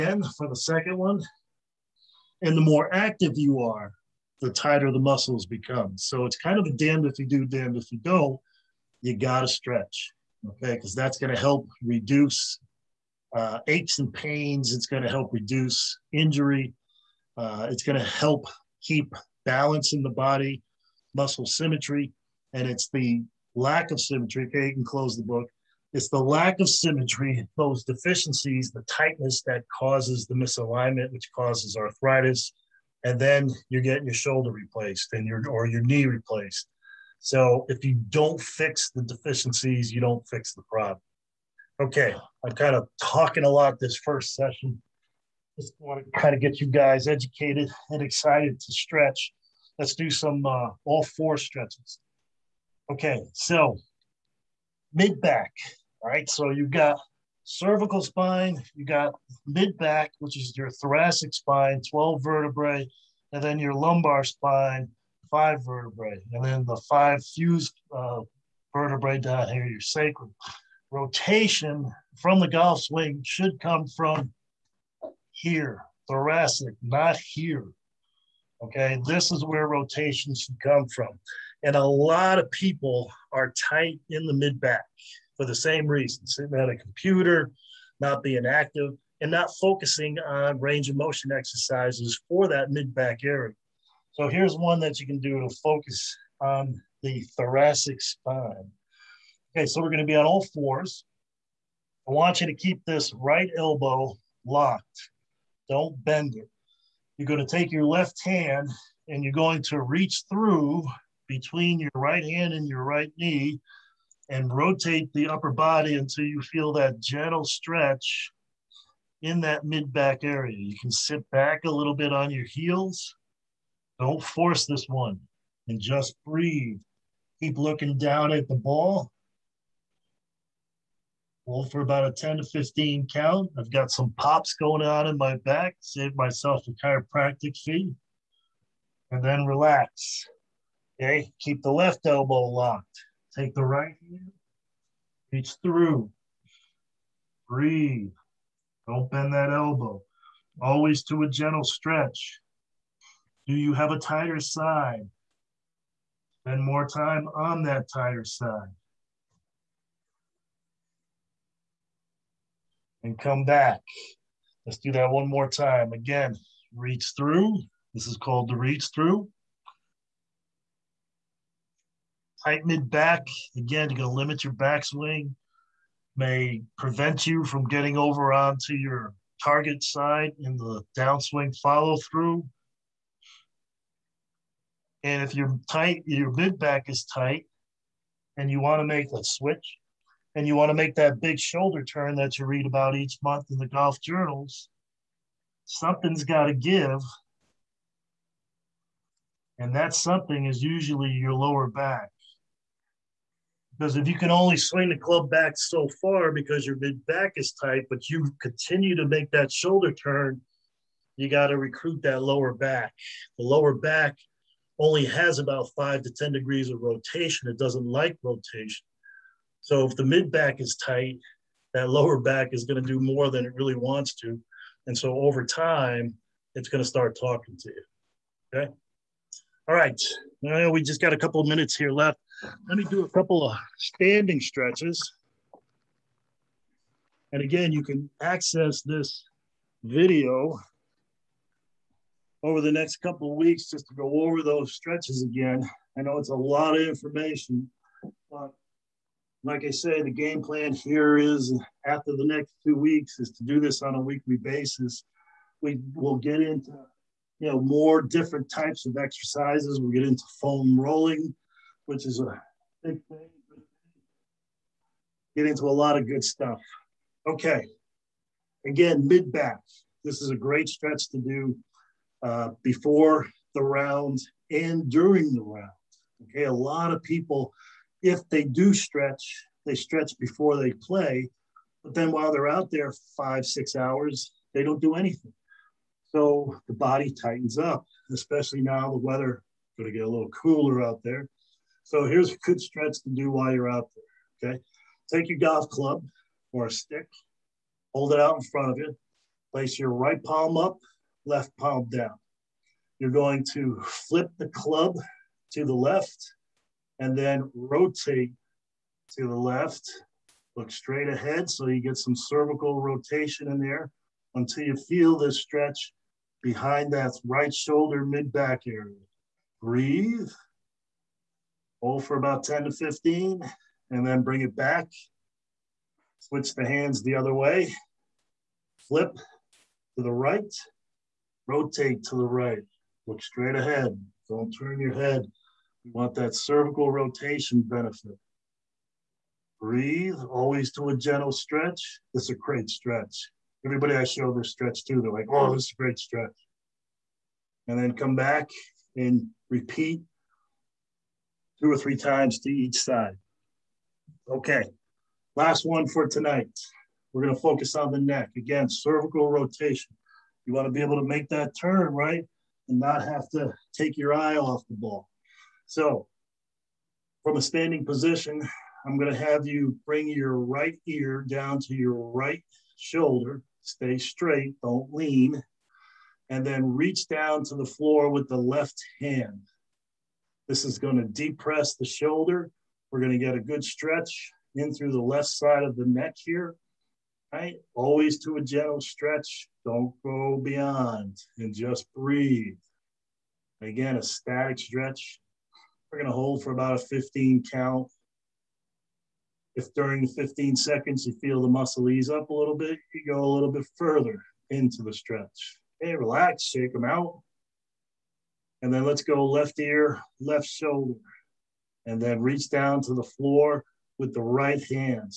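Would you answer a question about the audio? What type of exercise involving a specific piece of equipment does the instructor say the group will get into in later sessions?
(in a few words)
Foam rolling.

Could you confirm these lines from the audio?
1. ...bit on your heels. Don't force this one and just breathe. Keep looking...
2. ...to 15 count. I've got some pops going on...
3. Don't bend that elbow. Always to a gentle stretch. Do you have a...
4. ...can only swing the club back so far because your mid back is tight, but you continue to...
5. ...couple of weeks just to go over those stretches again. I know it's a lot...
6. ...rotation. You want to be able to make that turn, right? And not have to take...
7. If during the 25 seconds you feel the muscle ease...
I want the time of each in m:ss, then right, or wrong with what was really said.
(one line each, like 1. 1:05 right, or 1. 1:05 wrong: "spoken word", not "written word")
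1. 2:01 right
2. 2:12 right
3. 2:28 right
4. 3:24 right
5. 4:02 right
6. 5:59 right
7. 6:39 wrong: "15", not "25".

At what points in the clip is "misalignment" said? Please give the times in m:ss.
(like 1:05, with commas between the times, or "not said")
0:30.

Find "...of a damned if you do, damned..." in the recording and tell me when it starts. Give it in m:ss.
0:06.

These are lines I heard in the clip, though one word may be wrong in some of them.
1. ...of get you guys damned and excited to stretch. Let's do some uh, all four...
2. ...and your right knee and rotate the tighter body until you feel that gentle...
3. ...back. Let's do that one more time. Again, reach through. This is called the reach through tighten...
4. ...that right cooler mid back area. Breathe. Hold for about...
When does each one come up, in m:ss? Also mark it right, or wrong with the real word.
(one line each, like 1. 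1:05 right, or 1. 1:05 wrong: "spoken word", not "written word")
1. 0:46 wrong: "educated", not "damned"
2. 1:52 wrong: "upper", not "tighter"
3. 2:43 right
4. 5:16 wrong: "shoulder", not "cooler".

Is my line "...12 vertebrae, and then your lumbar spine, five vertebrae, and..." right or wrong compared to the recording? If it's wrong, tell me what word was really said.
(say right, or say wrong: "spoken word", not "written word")
right.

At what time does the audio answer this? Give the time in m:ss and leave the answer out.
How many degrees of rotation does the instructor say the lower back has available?
3:35.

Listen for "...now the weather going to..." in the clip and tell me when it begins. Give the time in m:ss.
4:48.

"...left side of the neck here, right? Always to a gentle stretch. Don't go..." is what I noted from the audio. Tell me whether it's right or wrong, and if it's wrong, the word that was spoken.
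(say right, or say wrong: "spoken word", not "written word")
right.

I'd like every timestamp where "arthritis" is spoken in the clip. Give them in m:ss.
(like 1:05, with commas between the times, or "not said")
0:31.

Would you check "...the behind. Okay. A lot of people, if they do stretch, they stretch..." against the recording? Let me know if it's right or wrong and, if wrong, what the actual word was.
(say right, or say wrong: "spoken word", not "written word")
wrong: "round", not "behind".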